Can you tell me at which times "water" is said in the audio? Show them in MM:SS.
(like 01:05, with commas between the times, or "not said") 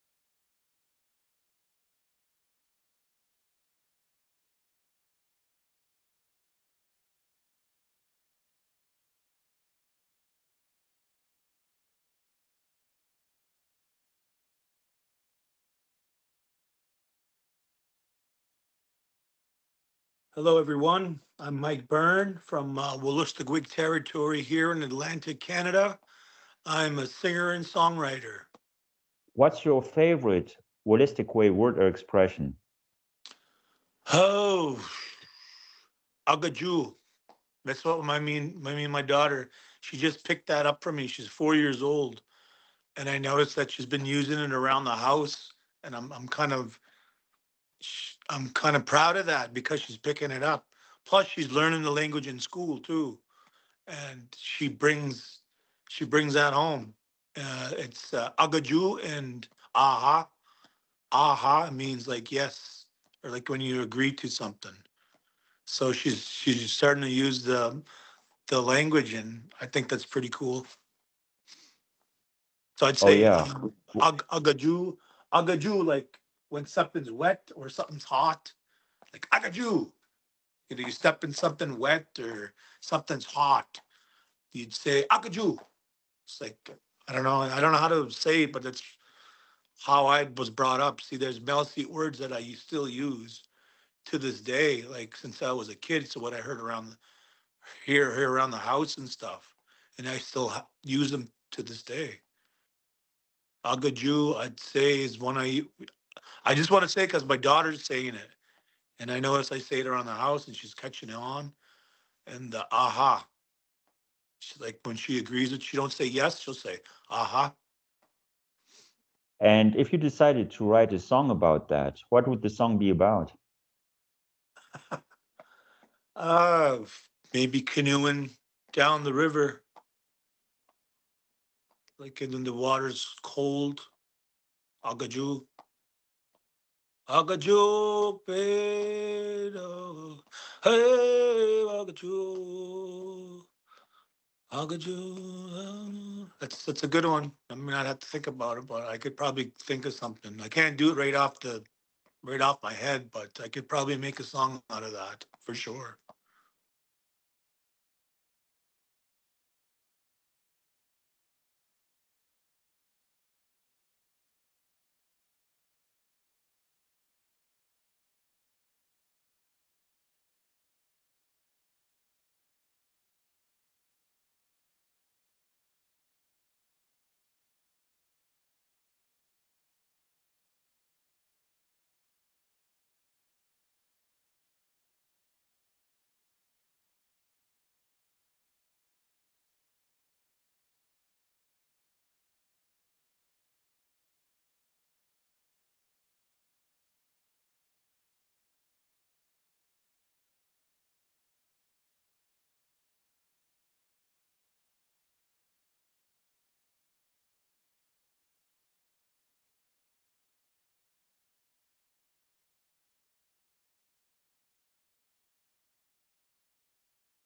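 02:12.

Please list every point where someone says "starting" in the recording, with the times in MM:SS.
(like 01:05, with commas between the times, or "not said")
01:06.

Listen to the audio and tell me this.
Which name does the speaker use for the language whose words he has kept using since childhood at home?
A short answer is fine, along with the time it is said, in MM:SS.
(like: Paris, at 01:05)
Maliseet, at 01:31.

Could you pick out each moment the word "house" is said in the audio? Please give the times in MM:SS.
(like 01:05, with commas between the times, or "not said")
00:44, 01:38, 01:50.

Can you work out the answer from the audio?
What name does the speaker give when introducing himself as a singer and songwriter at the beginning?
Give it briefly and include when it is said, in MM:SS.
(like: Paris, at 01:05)
Mike Bern, at 00:21.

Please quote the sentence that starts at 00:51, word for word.
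Plus, she's learning the language in school too, and she brings she brings that home.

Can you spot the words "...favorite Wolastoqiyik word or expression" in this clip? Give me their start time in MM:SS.
00:29.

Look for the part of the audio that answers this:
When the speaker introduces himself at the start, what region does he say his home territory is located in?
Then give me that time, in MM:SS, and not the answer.
00:24.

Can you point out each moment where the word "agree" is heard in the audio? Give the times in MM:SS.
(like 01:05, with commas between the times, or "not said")
01:03, 01:55.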